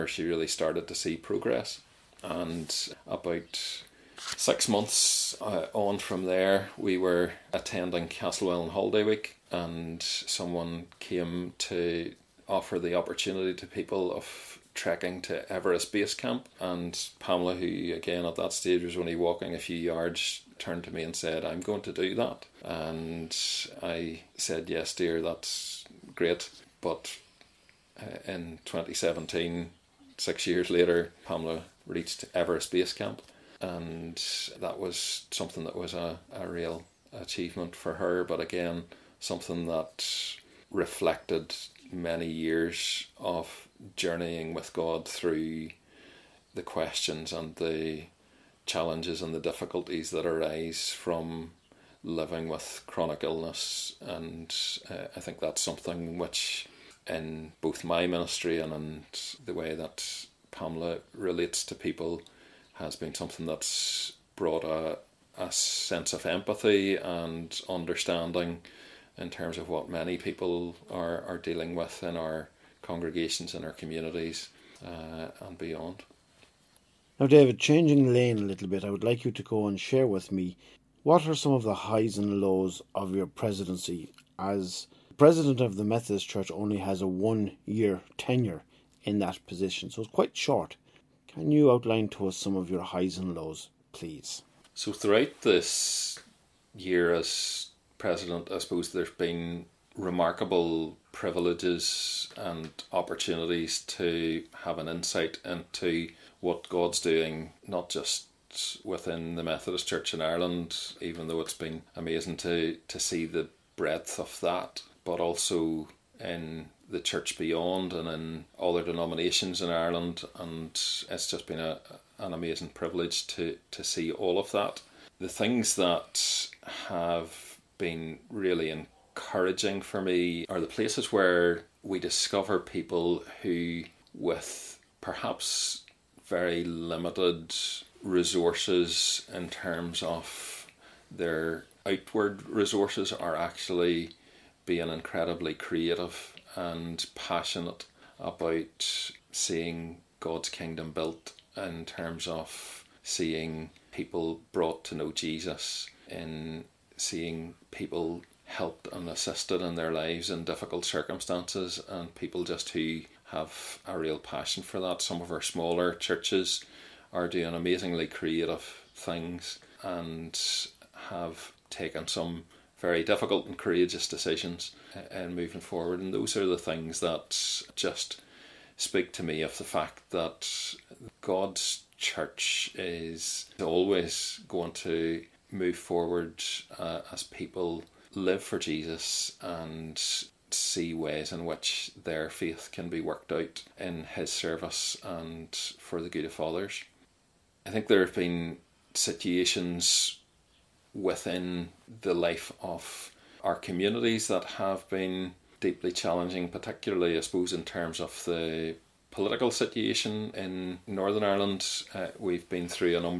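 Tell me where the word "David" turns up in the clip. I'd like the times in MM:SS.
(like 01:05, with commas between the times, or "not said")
01:17.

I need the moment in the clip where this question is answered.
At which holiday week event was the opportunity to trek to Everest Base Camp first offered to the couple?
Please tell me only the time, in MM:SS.
00:08.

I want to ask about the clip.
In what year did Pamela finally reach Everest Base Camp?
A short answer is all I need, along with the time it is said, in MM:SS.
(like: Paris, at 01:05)
2017, at 00:28.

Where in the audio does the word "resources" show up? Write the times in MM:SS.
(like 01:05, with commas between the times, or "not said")
02:18, 02:22.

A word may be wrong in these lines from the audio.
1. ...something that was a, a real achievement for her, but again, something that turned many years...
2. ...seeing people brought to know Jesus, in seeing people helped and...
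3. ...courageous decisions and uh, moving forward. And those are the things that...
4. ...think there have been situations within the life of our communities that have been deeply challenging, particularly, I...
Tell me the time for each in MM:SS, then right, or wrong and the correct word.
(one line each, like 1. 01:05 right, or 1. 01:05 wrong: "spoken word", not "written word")
1. 00:35 wrong: "reflected", not "turned"
2. 02:33 right
3. 02:53 right
4. 03:17 right.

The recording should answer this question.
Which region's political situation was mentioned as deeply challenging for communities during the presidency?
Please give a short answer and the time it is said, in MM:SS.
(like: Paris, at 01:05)
Northern Ireland, at 03:30.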